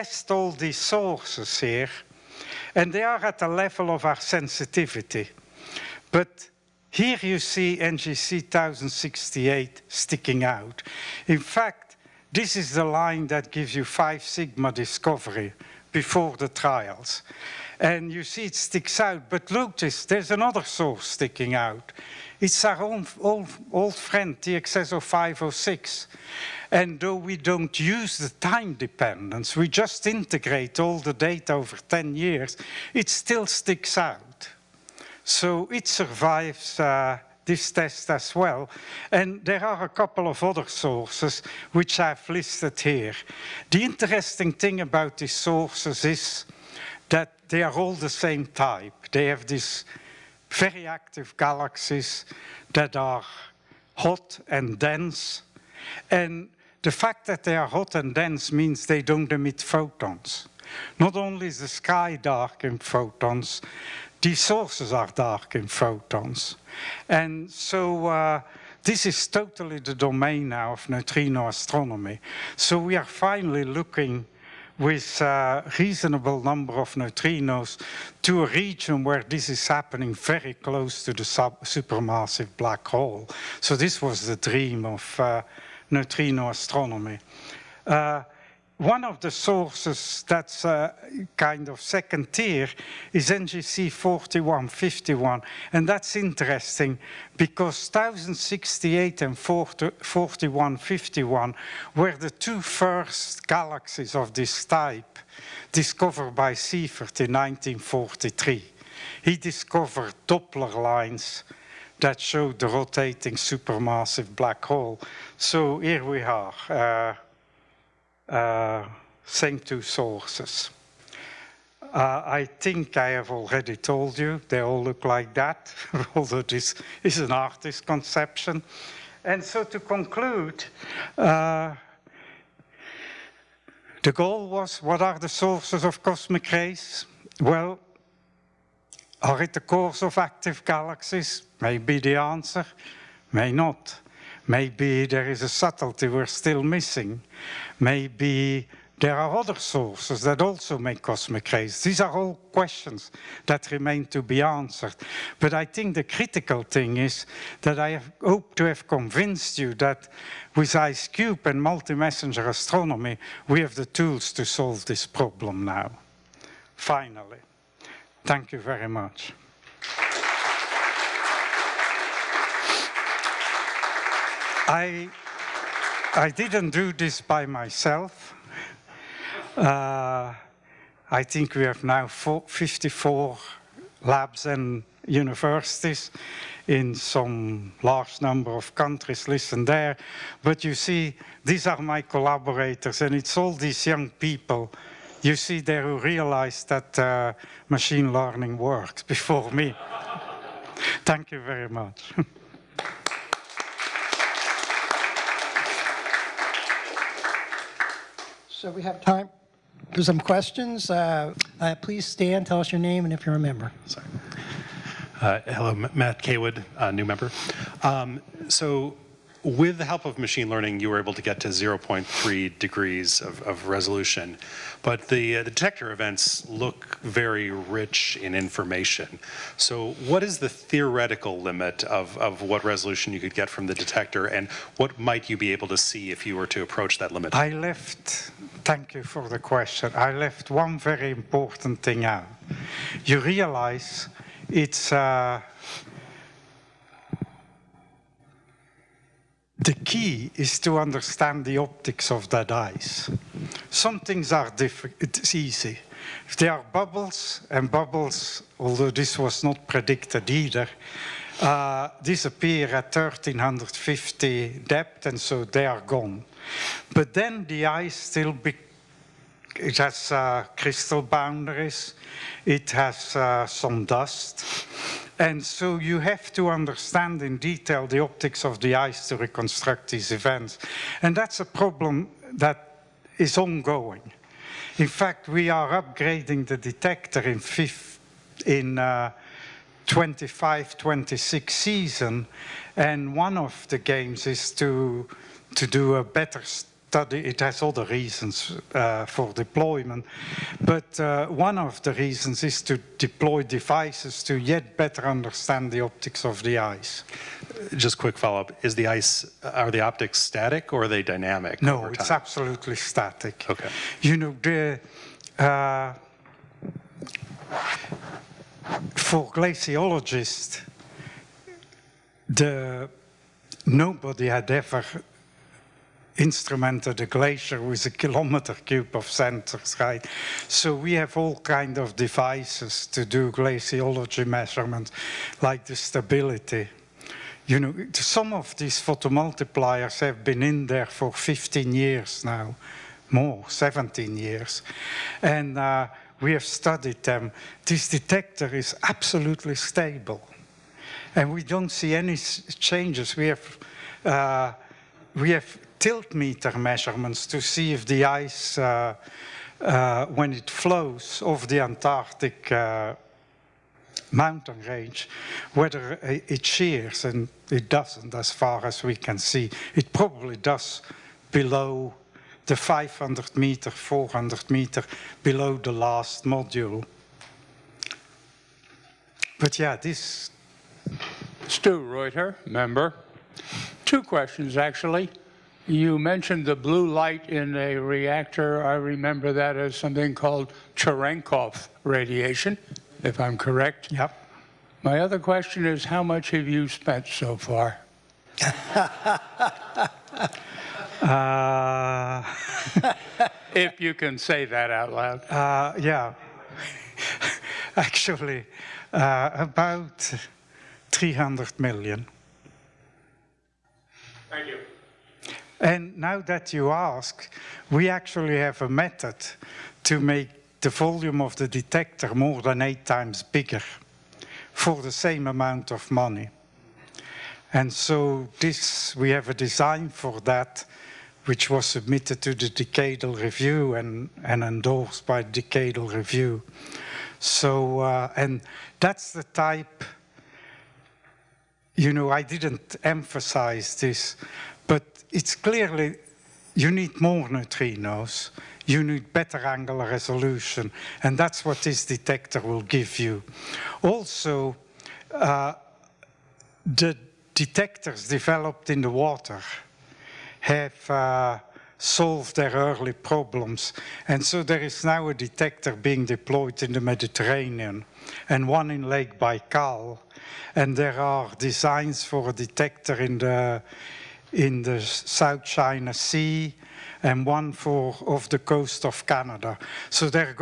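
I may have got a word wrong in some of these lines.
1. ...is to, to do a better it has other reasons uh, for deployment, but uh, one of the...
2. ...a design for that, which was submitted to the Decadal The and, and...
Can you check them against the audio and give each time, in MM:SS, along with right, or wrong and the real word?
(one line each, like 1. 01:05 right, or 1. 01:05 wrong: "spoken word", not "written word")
1. 04:54 right
2. 07:09 wrong: "Review", not "The".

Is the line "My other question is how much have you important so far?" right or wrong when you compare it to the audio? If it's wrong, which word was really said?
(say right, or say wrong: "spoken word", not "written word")
wrong: "spent", not "important".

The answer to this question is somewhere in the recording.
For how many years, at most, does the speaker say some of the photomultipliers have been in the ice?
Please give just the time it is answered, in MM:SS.
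05:43.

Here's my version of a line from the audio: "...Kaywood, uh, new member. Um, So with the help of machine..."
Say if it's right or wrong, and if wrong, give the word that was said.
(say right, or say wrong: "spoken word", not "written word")
right.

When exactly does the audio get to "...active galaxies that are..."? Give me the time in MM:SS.
00:50.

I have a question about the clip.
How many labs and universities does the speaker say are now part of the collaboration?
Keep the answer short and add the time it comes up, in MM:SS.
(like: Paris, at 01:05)
54, at 03:02.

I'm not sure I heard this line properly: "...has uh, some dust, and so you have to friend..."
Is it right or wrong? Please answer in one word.
wrong.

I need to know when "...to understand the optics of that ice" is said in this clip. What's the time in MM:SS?
04:10.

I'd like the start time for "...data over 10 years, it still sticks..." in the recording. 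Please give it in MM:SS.
00:31.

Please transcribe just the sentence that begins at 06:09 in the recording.
It probably does below the 500 meter, 400 meter below the last module.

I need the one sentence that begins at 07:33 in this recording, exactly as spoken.
Also, uh, the detectors developed in the water have uh, solved their early problems.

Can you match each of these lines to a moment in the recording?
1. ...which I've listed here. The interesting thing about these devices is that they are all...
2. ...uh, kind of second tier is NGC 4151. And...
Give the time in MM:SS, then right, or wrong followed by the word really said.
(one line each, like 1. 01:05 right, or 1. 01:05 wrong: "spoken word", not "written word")
1. 00:41 wrong: "sources", not "devices"
2. 01:30 right.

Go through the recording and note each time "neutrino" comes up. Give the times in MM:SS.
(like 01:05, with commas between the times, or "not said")
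01:10, 01:16, 01:25, 07:27.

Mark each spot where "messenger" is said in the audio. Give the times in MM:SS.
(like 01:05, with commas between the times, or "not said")
02:41.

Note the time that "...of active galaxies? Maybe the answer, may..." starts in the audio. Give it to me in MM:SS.
02:20.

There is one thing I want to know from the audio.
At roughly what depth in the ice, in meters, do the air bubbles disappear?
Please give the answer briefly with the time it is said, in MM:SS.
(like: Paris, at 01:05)
1350, at 04:22.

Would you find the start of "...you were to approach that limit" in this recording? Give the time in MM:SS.
03:56.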